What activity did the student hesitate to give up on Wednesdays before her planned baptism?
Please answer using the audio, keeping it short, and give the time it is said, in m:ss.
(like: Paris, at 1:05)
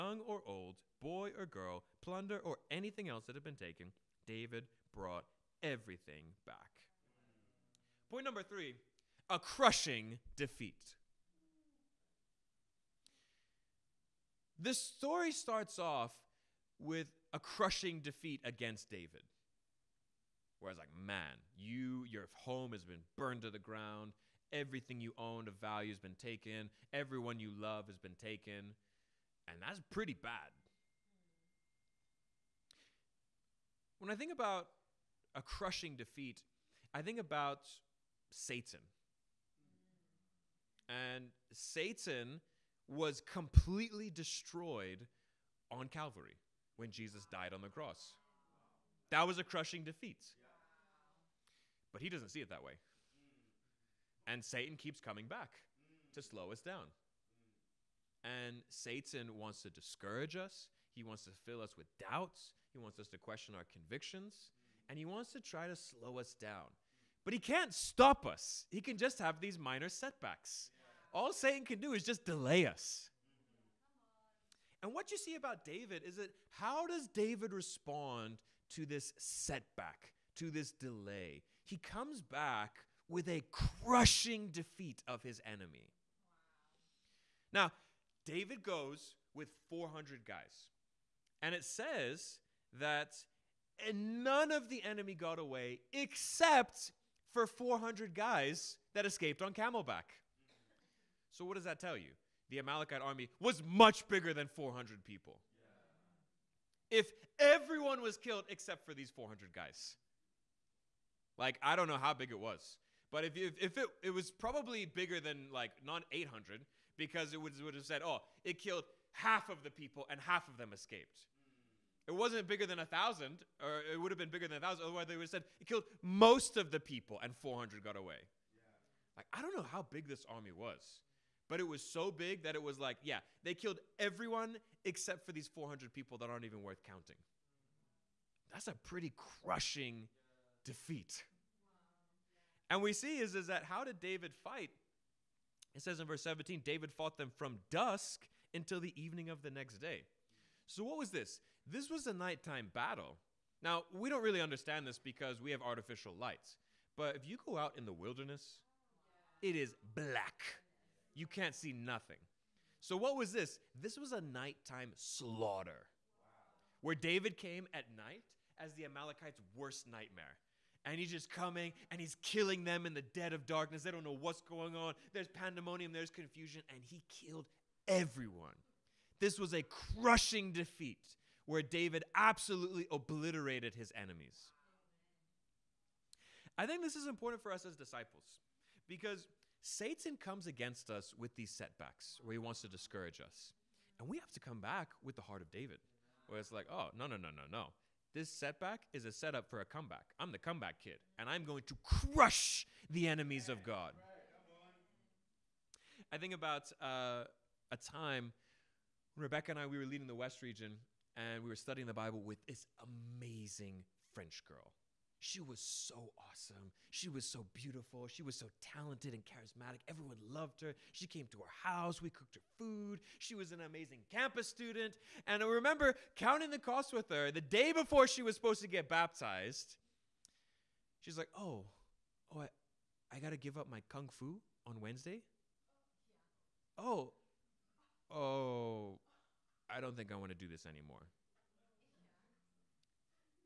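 Kung fu, at 3:53.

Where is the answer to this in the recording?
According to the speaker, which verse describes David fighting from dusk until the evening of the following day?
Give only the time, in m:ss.
2:26.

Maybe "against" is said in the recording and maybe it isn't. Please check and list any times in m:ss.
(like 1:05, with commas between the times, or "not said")
0:18, 3:10.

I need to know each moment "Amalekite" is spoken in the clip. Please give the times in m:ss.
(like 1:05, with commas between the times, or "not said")
1:42, 2:48.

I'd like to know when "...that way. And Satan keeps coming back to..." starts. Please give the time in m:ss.
0:52.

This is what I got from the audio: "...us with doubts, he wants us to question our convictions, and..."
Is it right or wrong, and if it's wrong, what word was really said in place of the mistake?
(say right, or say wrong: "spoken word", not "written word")
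right.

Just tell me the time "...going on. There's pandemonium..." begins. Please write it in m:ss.
2:54.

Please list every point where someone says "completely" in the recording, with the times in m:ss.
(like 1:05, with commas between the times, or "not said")
0:43.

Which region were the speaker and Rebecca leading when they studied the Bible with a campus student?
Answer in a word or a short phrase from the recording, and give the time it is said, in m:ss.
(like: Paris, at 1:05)
The West region, at 3:30.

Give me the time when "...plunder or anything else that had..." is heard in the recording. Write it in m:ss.
0:02.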